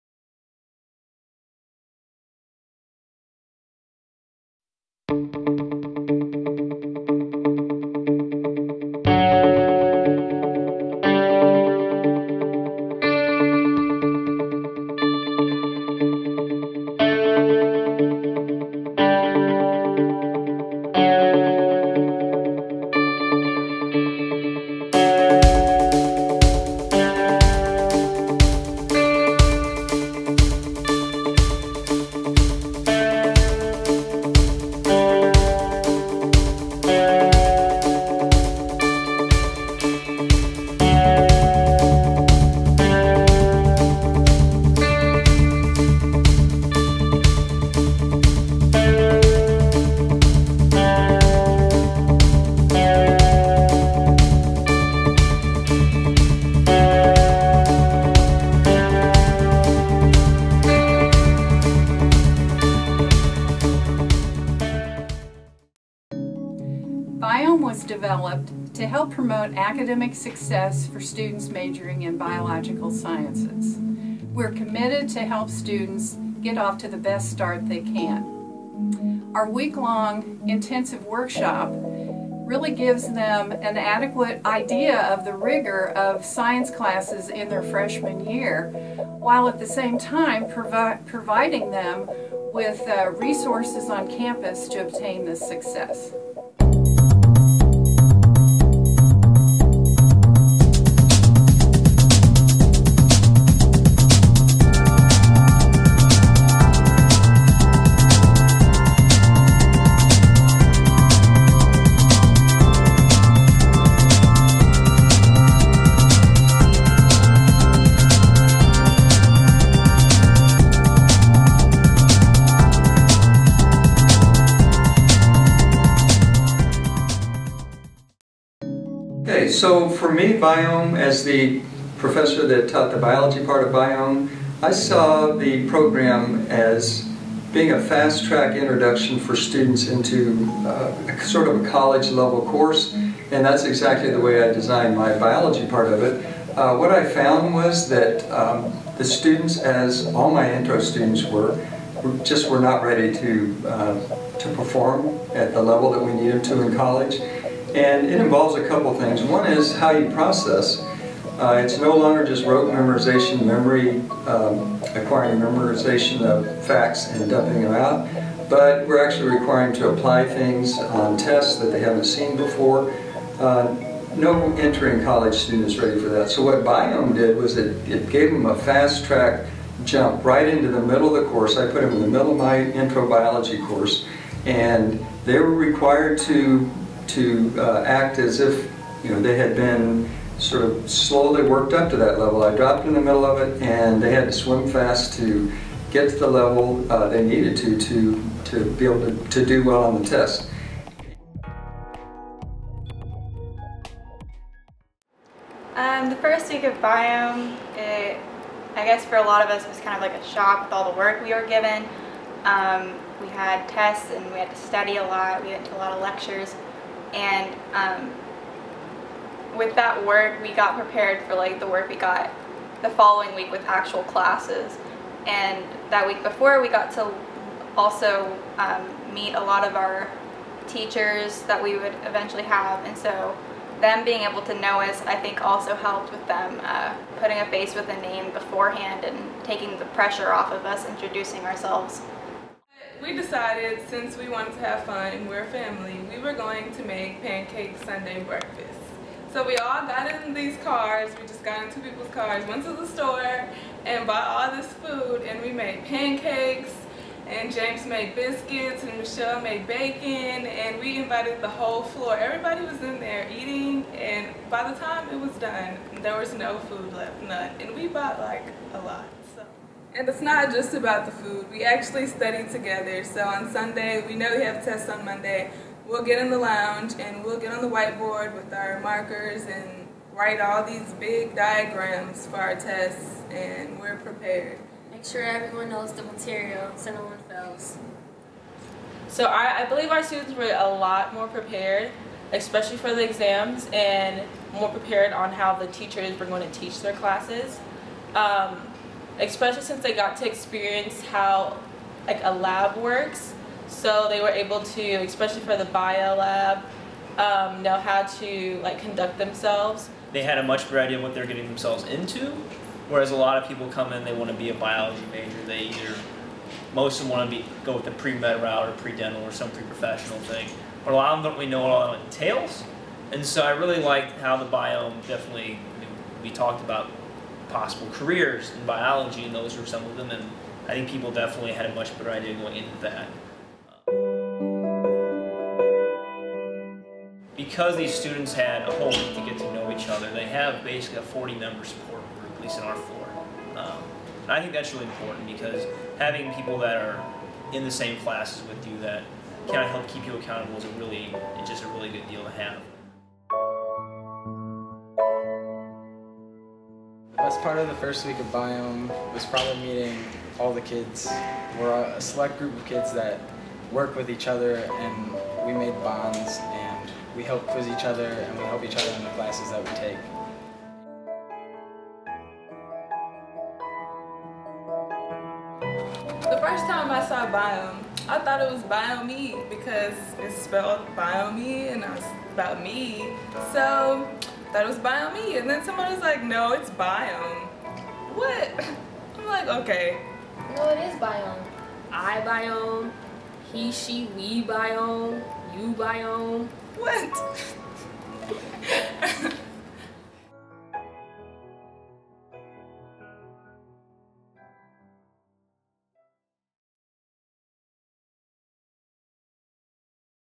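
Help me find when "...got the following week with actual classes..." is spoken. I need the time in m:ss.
3:41.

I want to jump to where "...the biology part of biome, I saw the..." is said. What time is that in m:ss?
2:12.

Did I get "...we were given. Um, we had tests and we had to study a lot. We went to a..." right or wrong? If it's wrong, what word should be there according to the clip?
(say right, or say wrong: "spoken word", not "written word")
right.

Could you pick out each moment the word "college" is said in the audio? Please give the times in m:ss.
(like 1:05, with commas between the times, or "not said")
2:21, 2:36, 2:55.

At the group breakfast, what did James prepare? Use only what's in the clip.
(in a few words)
biscuits.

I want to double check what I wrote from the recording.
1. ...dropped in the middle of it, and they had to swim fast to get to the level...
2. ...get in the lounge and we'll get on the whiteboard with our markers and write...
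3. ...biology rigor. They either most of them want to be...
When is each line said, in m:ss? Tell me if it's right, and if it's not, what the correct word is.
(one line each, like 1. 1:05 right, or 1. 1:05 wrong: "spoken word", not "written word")
1. 3:12 right
2. 4:36 right
3. 5:14 wrong: "major", not "rigor".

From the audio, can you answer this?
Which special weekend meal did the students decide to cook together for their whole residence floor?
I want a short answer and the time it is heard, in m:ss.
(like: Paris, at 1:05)
pancake Sunday breakfast, at 4:07.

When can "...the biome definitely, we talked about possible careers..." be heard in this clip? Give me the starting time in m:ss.
5:24.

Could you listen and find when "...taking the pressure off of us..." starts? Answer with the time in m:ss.
3:59.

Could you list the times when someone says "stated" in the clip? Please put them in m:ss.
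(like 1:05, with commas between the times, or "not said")
not said.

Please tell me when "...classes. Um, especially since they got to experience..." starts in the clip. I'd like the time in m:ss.
4:56.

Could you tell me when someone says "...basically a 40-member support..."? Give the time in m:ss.
5:40.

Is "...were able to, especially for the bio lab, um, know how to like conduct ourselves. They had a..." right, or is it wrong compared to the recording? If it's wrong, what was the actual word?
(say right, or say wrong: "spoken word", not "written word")
wrong: "themselves", not "ourselves".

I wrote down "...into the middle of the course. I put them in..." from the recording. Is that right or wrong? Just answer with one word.
right.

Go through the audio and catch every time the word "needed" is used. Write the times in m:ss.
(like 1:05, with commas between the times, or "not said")
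2:36, 3:17.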